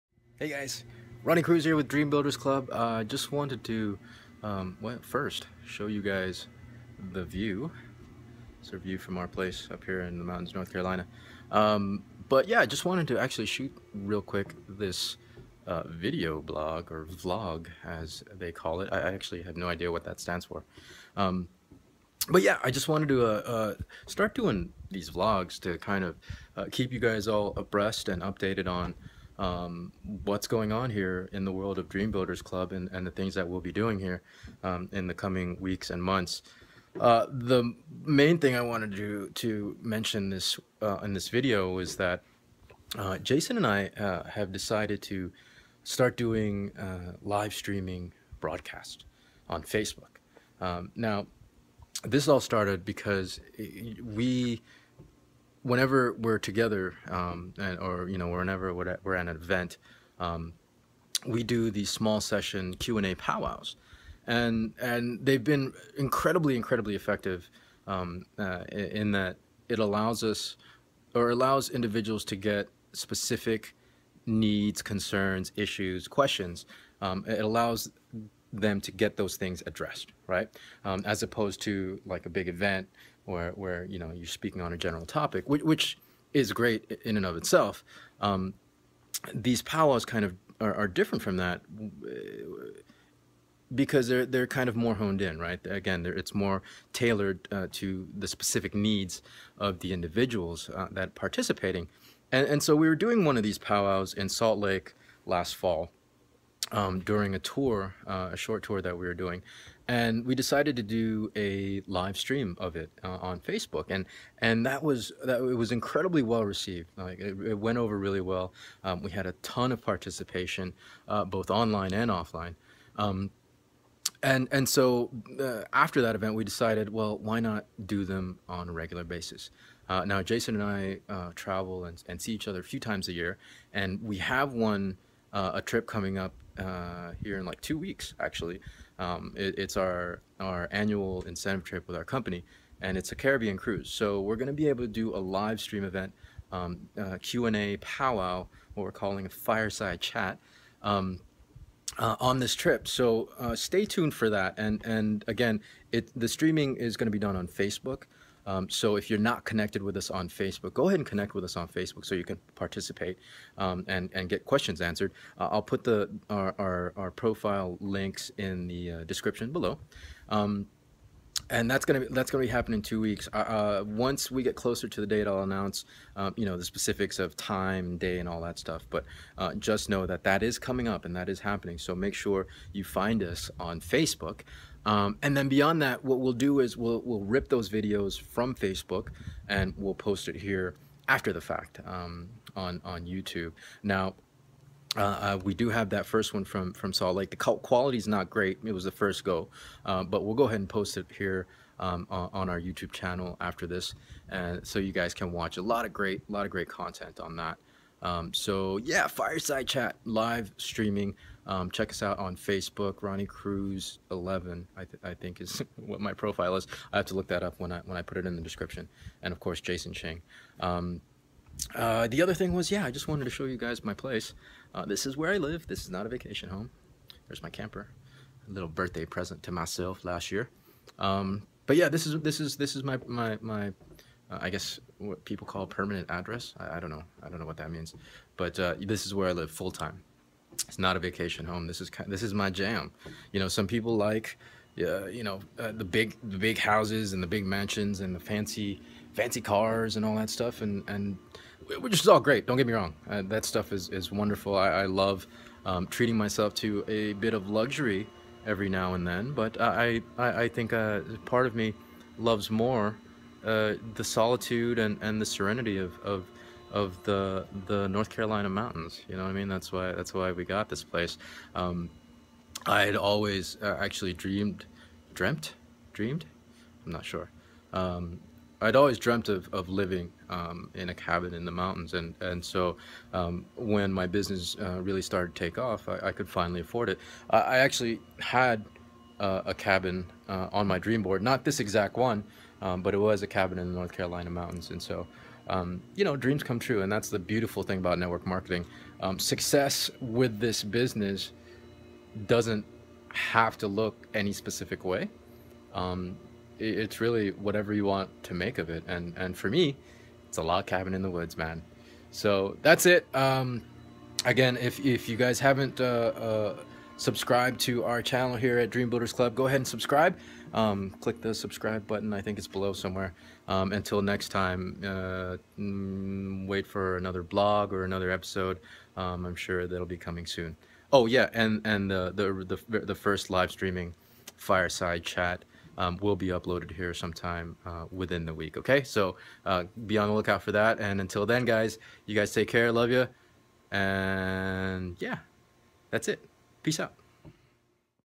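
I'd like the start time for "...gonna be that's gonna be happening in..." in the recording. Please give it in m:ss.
2:51.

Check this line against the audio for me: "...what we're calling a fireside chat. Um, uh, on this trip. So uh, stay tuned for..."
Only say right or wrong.
right.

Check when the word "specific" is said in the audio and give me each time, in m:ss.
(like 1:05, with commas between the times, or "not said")
1:12, 1:38, 2:56, 5:04.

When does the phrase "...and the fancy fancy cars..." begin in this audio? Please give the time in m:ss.
4:07.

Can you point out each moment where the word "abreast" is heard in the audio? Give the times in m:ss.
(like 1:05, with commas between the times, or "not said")
0:27.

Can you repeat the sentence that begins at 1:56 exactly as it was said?
Like it, it went over really well.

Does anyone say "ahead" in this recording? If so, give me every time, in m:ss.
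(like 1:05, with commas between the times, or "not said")
2:40, 3:20, 5:19.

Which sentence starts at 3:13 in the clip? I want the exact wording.
Now, uh, uh, we do have that first one from, from Salt Lake.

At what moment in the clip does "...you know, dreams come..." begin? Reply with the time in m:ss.
4:55.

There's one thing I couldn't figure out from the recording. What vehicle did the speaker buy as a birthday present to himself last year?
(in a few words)
Camper.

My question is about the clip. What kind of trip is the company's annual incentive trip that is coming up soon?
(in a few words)
Caribbean cruise.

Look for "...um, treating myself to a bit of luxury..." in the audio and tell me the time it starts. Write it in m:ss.
4:15.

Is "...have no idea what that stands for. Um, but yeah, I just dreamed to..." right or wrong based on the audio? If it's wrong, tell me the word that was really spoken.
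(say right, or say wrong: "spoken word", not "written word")
wrong: "wanted", not "dreamed".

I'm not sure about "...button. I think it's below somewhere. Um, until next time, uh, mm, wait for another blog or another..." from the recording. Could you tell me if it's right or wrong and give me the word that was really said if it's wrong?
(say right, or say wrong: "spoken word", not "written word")
right.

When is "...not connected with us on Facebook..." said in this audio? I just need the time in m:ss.
2:39.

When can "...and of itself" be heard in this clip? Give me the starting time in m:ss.
1:27.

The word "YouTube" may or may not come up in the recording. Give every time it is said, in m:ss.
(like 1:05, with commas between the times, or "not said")
3:13, 3:22.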